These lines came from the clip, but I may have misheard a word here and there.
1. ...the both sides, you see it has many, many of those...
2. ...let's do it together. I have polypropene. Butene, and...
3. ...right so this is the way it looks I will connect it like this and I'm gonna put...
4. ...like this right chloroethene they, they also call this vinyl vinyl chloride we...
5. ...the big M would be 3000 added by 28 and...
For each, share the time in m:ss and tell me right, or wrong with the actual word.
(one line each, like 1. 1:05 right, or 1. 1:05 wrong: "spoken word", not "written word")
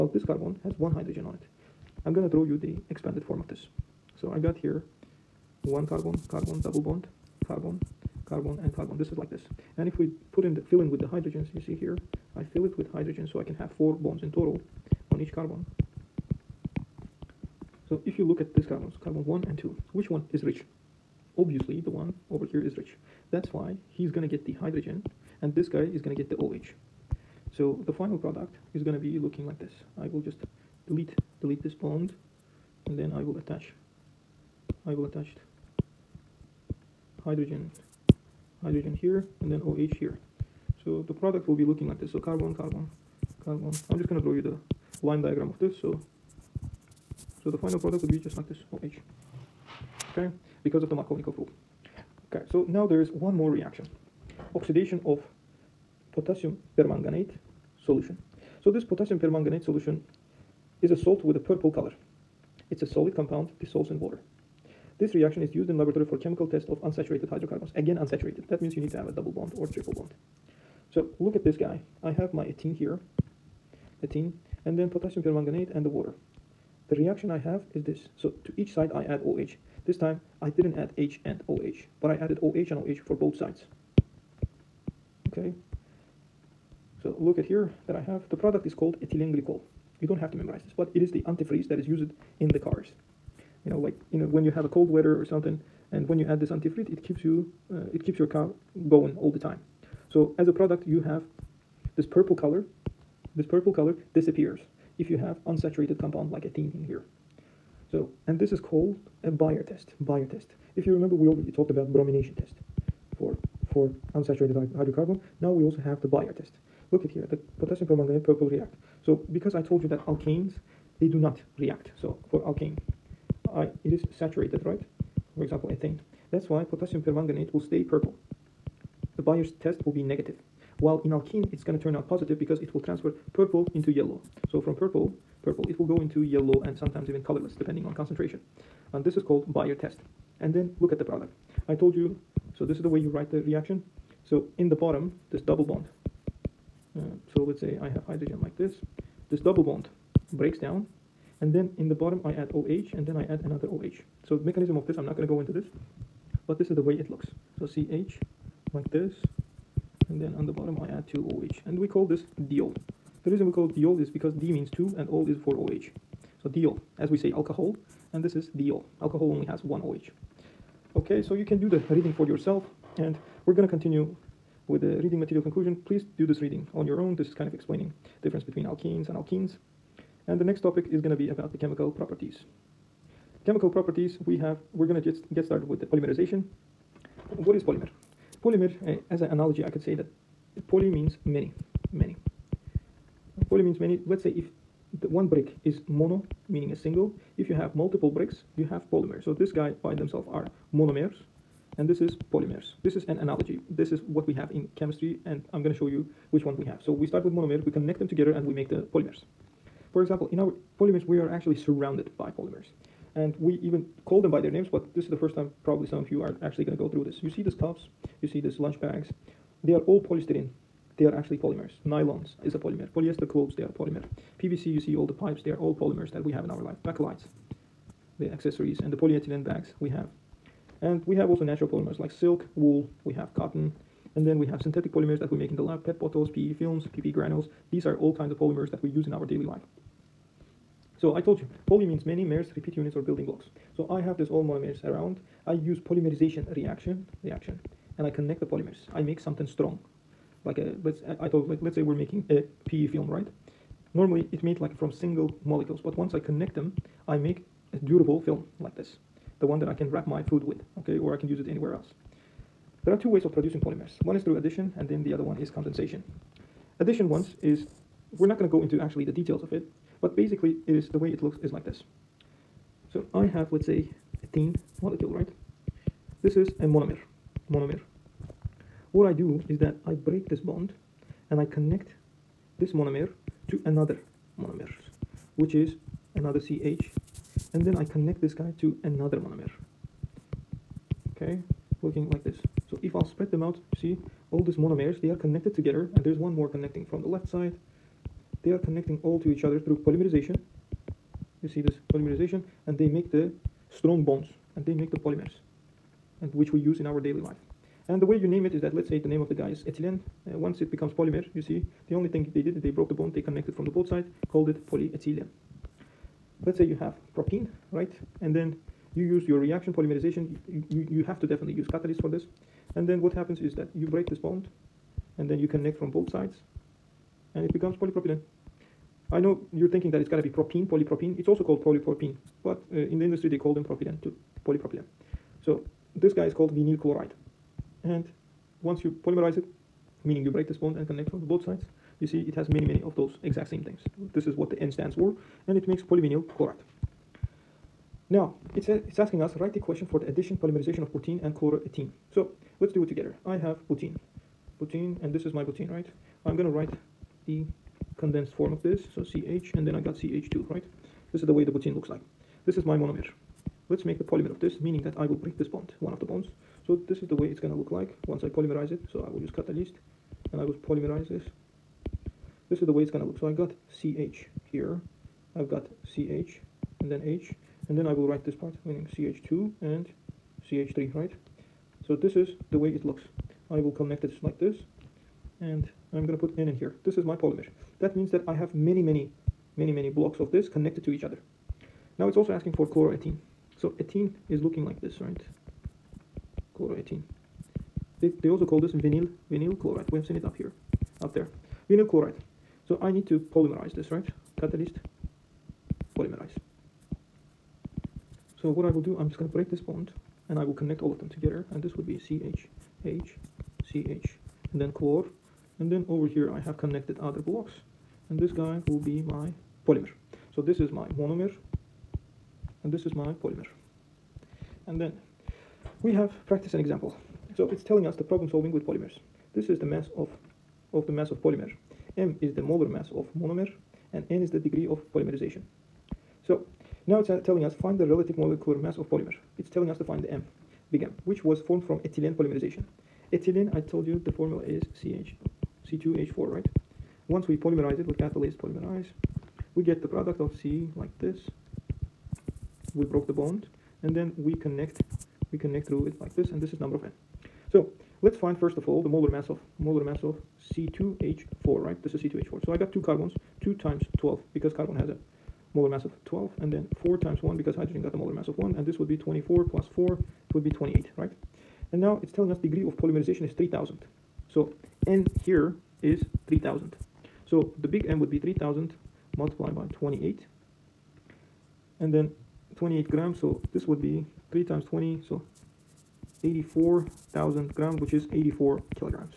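1. 5:41 right
2. 5:52 wrong: "butene", not "polypropene"
3. 6:20 right
4. 6:34 right
5. 7:57 wrong: "multiplied", not "added".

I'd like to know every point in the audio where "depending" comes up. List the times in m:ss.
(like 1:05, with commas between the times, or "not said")
2:17.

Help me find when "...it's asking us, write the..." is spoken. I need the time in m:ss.
5:48.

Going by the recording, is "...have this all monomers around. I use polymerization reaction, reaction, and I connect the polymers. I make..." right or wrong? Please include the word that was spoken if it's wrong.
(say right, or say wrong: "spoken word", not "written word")
right.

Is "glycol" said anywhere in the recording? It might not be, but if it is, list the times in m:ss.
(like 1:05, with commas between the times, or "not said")
1:29.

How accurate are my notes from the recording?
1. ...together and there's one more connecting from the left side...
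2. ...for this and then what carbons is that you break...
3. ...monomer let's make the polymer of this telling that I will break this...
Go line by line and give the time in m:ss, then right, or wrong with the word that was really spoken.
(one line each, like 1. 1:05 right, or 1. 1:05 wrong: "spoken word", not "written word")
1. 4:55 right
2. 5:22 wrong: "happens", not "carbons"
3. 6:02 wrong: "meaning", not "telling".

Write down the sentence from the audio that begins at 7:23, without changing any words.
Ethylene, I told you the formula is CH, C2H4, right?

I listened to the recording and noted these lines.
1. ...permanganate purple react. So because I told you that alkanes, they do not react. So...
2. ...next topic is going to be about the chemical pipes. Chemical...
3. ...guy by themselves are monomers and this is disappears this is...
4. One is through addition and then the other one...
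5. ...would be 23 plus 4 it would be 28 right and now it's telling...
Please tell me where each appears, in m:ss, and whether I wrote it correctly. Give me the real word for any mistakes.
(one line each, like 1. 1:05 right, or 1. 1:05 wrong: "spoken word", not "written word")
1. 1:57 right
2. 3:00 wrong: "properties", not "pipes"
3. 3:19 wrong: "polymers", not "disappears"
4. 4:24 right
5. 7:48 wrong: "24", not "23".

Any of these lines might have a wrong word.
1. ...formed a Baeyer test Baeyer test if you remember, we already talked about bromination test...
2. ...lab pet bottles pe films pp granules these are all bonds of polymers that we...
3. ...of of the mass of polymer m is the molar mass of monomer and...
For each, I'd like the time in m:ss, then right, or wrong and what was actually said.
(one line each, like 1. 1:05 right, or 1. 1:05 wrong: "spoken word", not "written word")
1. 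1:48 wrong: "called", not "formed"
2. 3:55 wrong: "kinds", not "bonds"
3. 7:09 right.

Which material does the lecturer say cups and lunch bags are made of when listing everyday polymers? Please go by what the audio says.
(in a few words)
polystyrene.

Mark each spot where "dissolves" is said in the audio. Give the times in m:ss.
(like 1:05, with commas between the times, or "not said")
1:03.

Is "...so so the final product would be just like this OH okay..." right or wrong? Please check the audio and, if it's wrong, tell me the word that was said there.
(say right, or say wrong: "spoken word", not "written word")
right.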